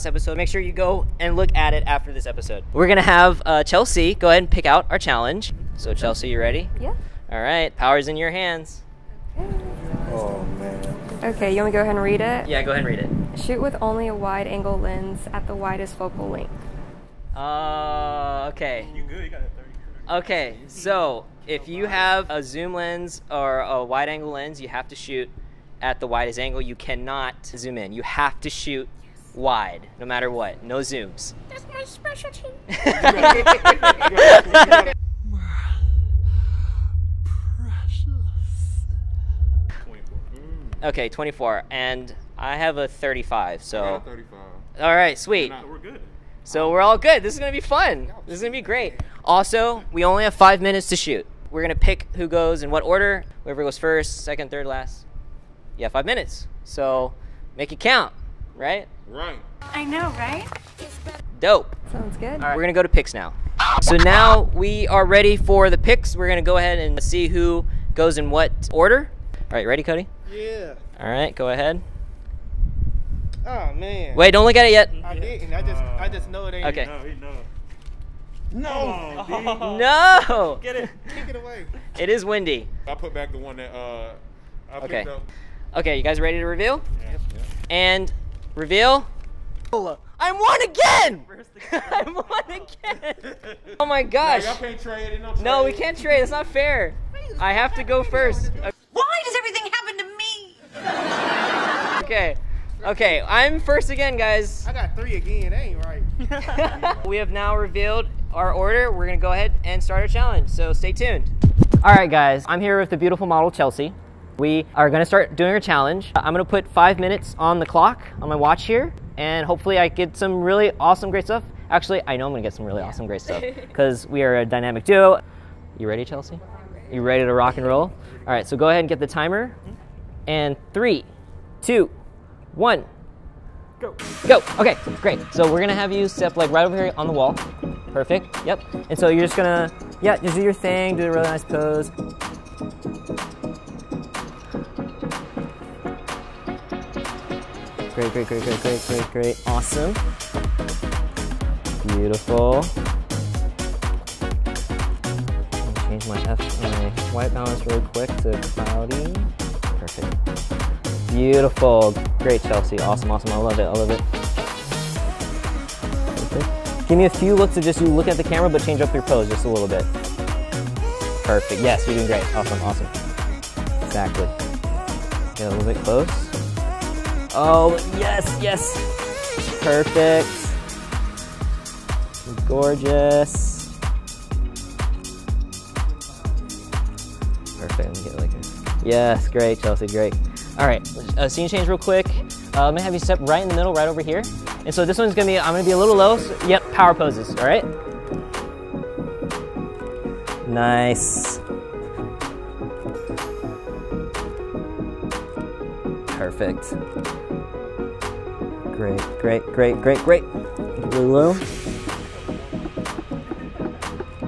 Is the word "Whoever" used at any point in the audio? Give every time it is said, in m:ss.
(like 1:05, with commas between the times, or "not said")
0:53.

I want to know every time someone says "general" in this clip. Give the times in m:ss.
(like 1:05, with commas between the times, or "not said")
not said.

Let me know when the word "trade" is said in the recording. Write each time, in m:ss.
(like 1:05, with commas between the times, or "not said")
1:35.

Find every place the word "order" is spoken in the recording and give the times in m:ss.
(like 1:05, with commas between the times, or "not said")
0:52, 1:08, 1:48.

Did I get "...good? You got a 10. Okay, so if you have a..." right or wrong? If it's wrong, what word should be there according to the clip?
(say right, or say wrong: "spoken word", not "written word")
wrong: "30", not "10".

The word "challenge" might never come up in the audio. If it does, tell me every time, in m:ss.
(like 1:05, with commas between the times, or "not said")
0:04, 1:50, 1:55.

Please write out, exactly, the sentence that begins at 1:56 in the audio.
I'm gonna put five minutes on the clock on my watch here, and hopefully I get some really awesome, great stuff.